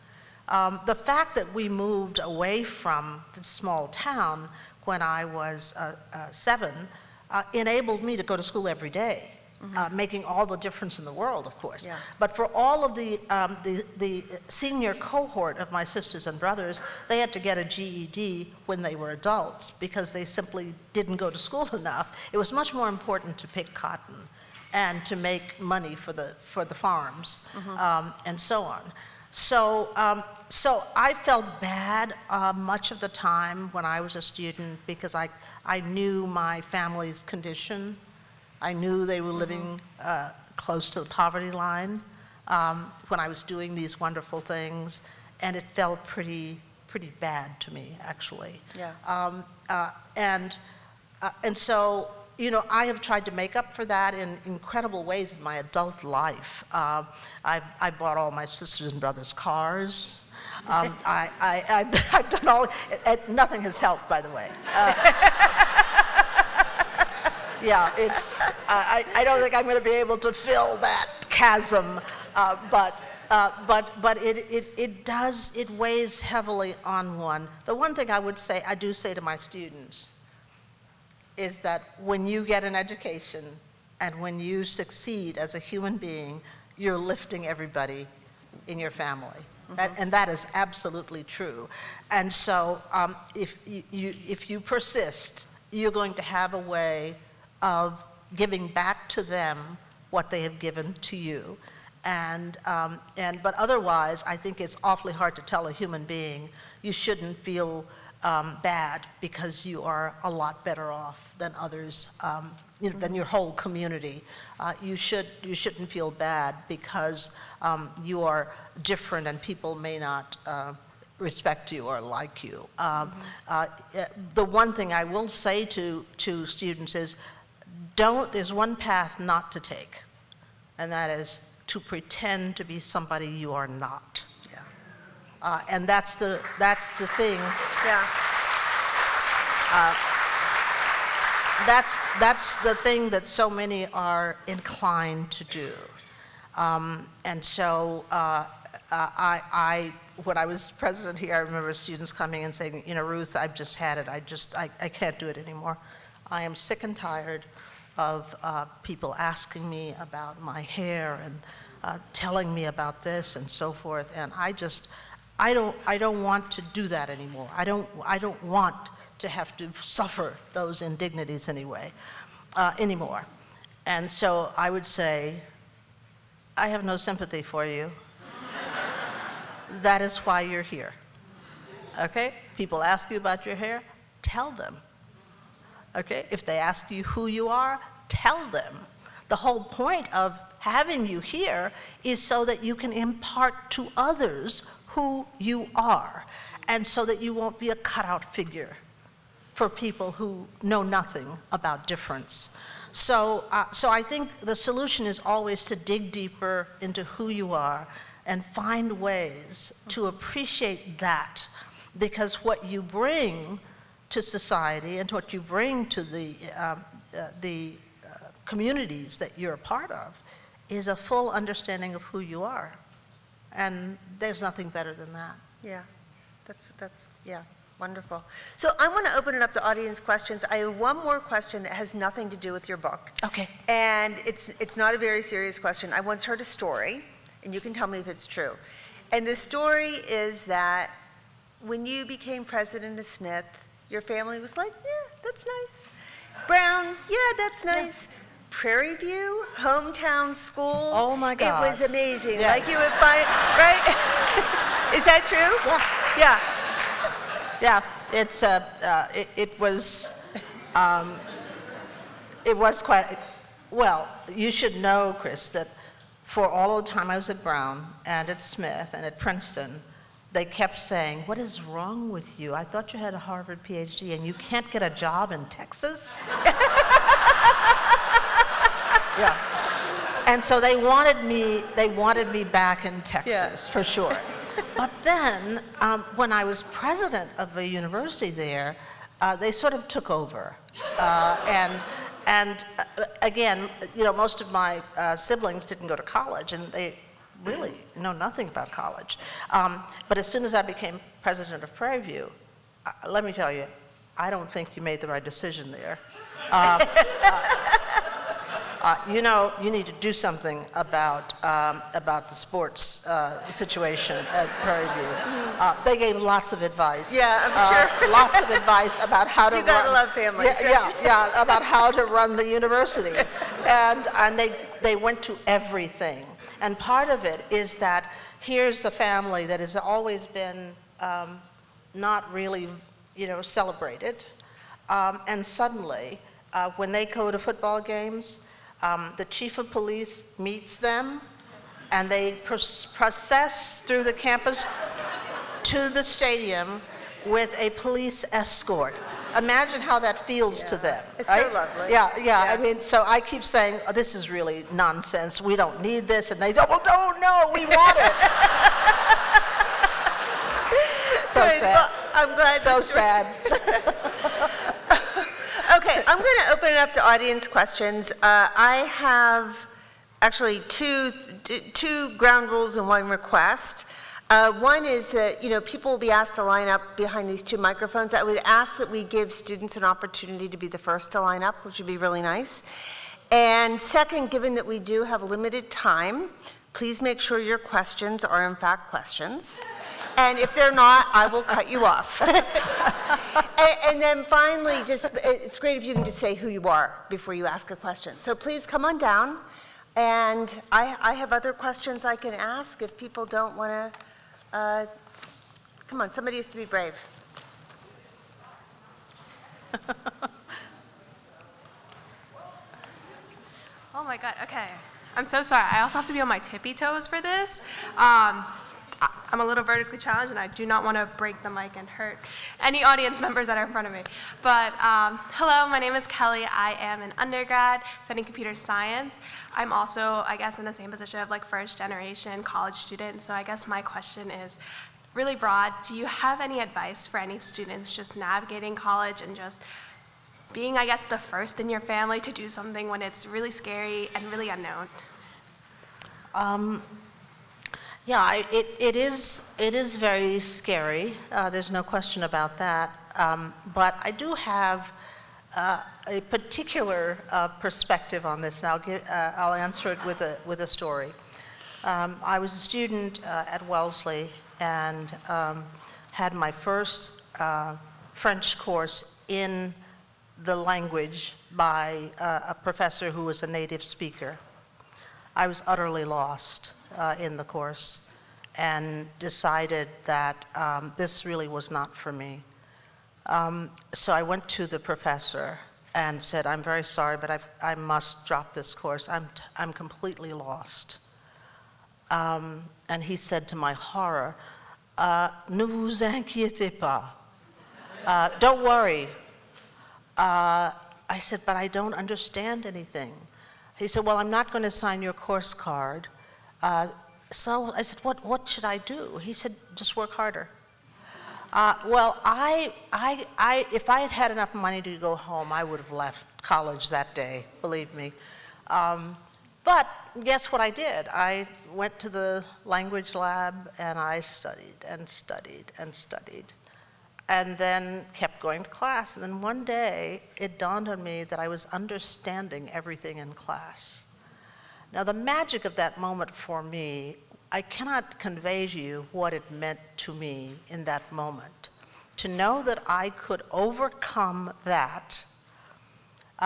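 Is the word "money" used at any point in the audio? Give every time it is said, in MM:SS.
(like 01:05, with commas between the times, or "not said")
00:25, 08:34.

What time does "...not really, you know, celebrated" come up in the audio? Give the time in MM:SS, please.
05:31.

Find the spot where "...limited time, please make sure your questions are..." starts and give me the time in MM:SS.
06:25.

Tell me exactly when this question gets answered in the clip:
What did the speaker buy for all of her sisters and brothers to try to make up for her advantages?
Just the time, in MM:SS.
00:59.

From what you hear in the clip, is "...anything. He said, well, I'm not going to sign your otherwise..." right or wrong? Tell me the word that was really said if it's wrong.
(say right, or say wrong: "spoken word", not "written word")
wrong: "course", not "otherwise".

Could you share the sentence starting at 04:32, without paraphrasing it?
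I thought you had a Harvard PhD and you can't get a job in Texas?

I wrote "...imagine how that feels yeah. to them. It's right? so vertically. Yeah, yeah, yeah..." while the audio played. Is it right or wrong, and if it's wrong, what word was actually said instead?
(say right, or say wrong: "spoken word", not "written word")
wrong: "lovely", not "vertically".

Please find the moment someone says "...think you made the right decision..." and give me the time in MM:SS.
05:04.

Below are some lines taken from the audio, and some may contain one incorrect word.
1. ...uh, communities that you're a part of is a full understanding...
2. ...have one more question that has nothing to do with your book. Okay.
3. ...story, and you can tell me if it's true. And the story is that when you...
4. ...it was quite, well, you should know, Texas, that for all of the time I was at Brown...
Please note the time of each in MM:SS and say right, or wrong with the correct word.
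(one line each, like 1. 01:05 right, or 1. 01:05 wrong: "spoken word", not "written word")
1. 03:38 right
2. 03:50 right
3. 03:56 right
4. 04:22 wrong: "Chris", not "Texas".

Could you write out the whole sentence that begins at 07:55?
I was utterly lost uh, in the course and decided that um, this really was not for me.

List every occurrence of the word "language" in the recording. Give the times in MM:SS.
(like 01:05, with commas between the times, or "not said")
07:50, 08:42.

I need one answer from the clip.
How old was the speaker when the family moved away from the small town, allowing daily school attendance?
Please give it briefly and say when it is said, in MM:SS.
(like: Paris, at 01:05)
7, at 00:06.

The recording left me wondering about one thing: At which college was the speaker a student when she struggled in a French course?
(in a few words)
Wellesley.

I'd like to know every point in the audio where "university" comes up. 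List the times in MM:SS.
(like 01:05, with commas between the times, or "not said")
04:47, 05:22.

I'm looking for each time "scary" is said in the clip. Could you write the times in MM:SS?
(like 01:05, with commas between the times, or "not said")
07:23, 07:30.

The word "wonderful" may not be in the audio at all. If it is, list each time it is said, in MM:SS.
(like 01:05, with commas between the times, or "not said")
00:43, 03:47.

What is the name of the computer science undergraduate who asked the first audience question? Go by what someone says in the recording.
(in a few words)
Kelly.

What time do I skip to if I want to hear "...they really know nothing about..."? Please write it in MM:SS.
04:56.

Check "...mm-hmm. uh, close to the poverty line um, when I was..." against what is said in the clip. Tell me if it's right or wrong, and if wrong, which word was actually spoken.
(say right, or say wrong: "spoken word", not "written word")
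right.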